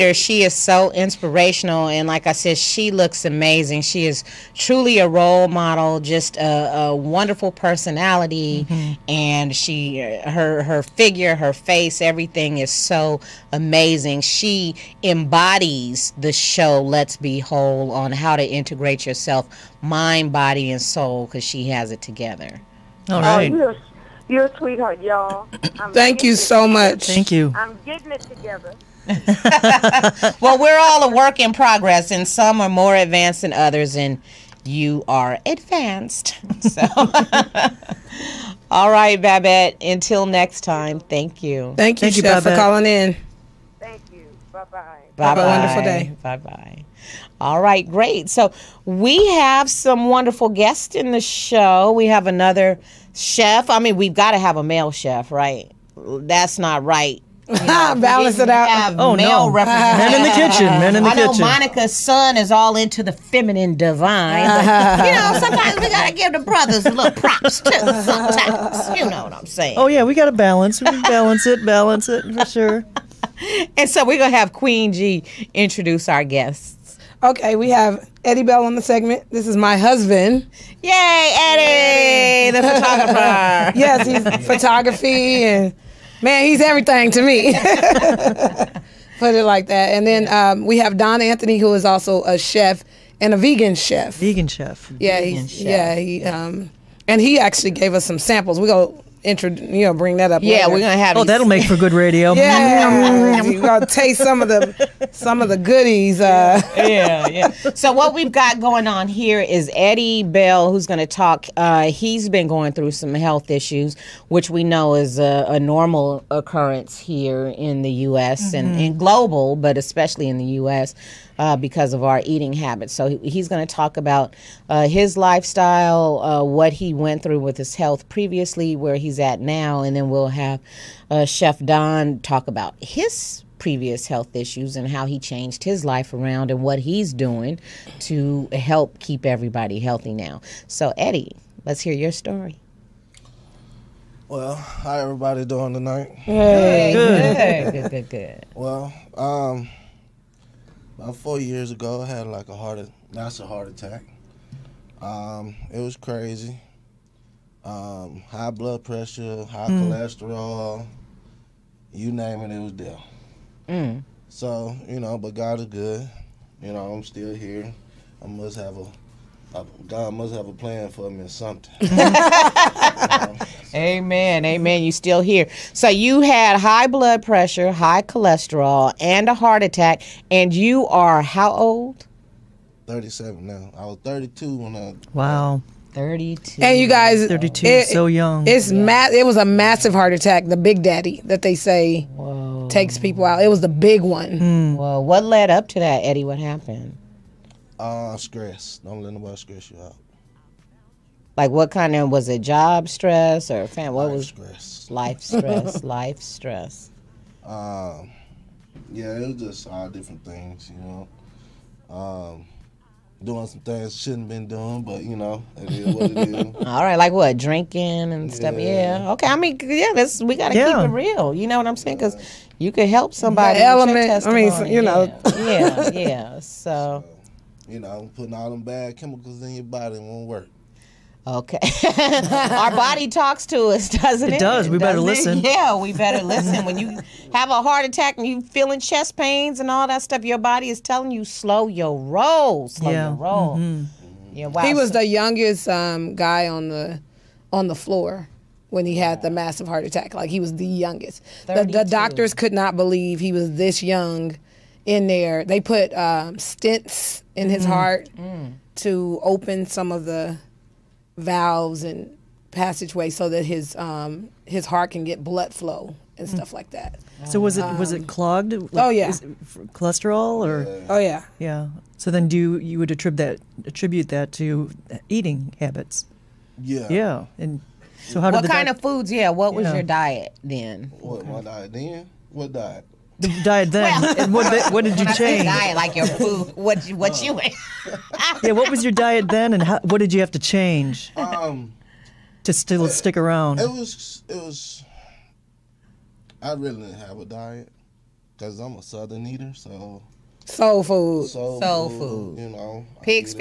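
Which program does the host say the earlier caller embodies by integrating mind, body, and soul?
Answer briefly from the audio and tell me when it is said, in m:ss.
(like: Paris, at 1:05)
Let's Be Whole, at 0:16.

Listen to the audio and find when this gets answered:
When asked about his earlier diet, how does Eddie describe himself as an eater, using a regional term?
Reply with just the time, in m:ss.
4:58.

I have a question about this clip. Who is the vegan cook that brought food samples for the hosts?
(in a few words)
Don Anthony.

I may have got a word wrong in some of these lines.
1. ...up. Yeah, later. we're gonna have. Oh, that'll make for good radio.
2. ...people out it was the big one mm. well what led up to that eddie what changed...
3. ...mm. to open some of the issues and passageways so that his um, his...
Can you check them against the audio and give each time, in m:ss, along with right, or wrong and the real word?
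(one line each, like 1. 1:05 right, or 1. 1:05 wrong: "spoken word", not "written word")
1. 1:40 right
2. 3:12 wrong: "happened", not "changed"
3. 4:18 wrong: "valves", not "issues".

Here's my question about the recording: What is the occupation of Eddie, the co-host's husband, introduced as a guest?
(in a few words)
Photographer.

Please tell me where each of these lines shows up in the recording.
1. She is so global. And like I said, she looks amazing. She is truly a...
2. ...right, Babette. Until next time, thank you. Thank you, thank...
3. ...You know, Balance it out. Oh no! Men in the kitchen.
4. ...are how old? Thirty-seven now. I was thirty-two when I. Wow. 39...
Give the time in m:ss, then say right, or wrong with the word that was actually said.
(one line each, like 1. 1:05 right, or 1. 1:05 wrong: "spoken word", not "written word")
1. 0:00 wrong: "inspirational", not "global"
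2. 0:38 right
3. 0:57 right
4. 3:00 wrong: "32", not "39".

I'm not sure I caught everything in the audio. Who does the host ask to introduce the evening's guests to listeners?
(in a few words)
Queen G.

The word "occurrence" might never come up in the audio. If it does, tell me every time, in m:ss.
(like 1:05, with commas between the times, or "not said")
1:56.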